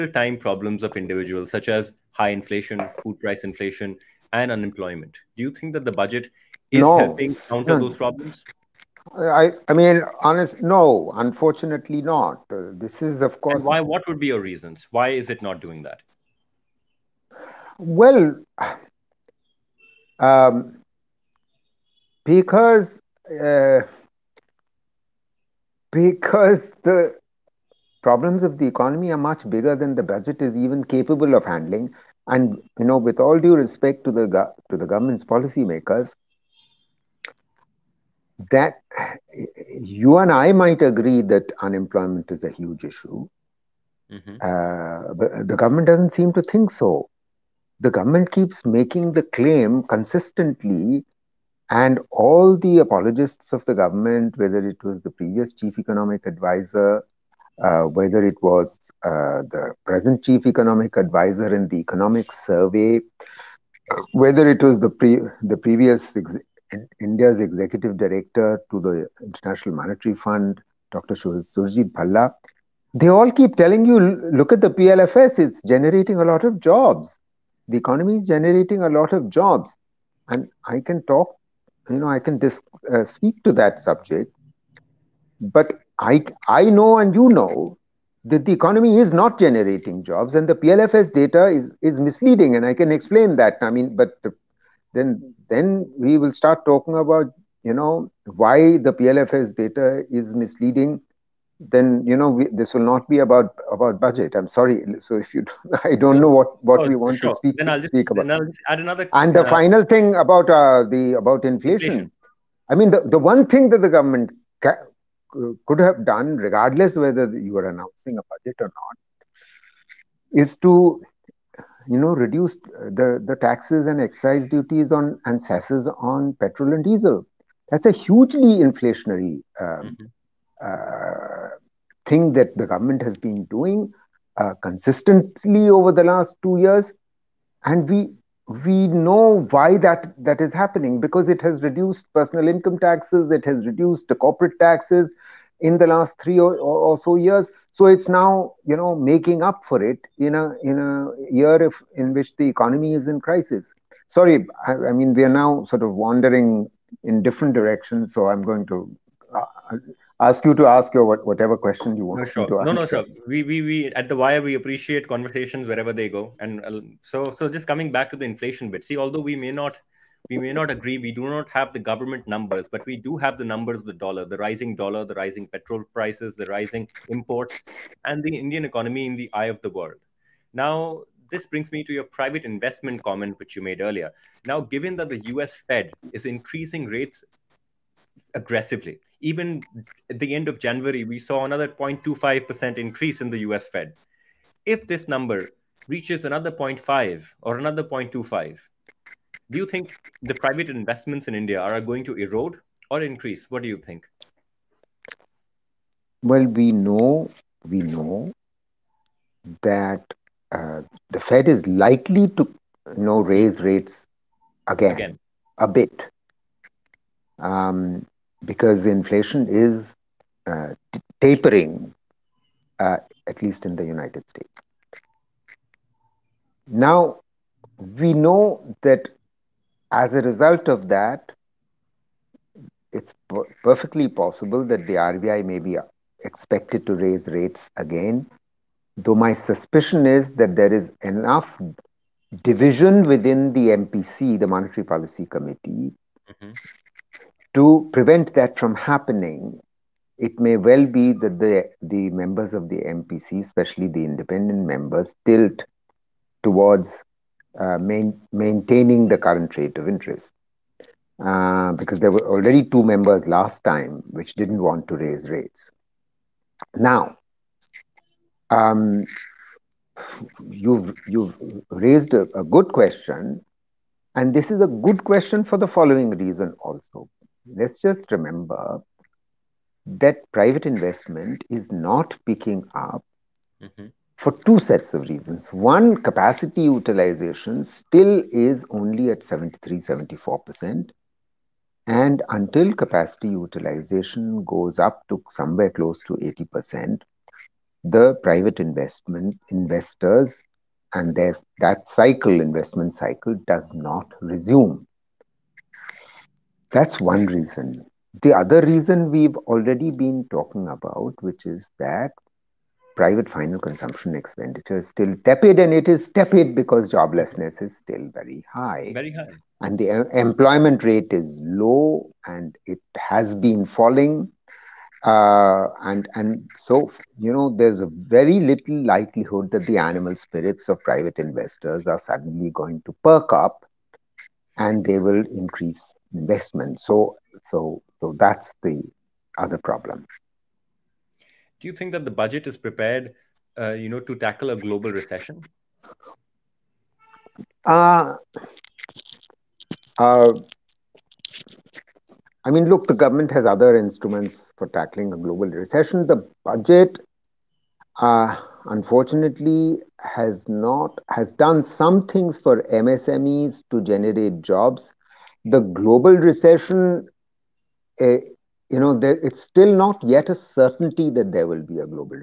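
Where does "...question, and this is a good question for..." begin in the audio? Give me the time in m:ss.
4:32.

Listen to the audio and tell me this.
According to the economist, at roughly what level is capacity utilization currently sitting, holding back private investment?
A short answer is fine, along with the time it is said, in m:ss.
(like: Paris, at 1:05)
73-74%, at 4:49.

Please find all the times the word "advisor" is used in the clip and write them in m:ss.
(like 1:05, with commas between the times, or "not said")
0:56, 1:00.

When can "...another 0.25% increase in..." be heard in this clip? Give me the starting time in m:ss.
3:11.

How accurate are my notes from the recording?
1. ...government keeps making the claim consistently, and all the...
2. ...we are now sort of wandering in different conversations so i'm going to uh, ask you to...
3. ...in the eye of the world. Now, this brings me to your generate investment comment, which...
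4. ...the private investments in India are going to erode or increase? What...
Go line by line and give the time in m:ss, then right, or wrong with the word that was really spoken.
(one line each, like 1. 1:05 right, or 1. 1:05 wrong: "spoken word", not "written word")
1. 0:47 right
2. 2:35 wrong: "directions", not "conversations"
3. 2:59 wrong: "private", not "generate"
4. 3:20 right.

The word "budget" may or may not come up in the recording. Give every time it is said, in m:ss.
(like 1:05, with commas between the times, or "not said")
0:05, 0:30, 1:43, 1:58, 5:42, 5:56.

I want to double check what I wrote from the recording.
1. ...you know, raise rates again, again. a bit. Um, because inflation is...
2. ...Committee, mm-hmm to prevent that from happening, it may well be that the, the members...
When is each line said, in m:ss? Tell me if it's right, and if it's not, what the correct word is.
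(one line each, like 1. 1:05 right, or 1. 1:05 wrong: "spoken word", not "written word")
1. 3:32 right
2. 4:05 right.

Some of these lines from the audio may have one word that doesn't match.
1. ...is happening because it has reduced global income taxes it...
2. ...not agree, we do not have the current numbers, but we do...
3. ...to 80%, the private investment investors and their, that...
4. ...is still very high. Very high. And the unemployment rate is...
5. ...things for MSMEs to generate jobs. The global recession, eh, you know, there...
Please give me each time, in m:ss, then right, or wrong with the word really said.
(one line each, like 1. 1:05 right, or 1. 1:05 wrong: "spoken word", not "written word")
1. 2:20 wrong: "personal", not "global"
2. 2:50 wrong: "government", not "current"
3. 4:56 right
4. 5:17 wrong: "employment", not "unemployment"
5. 6:02 right.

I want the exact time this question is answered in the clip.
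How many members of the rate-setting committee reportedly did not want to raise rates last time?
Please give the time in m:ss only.
4:22.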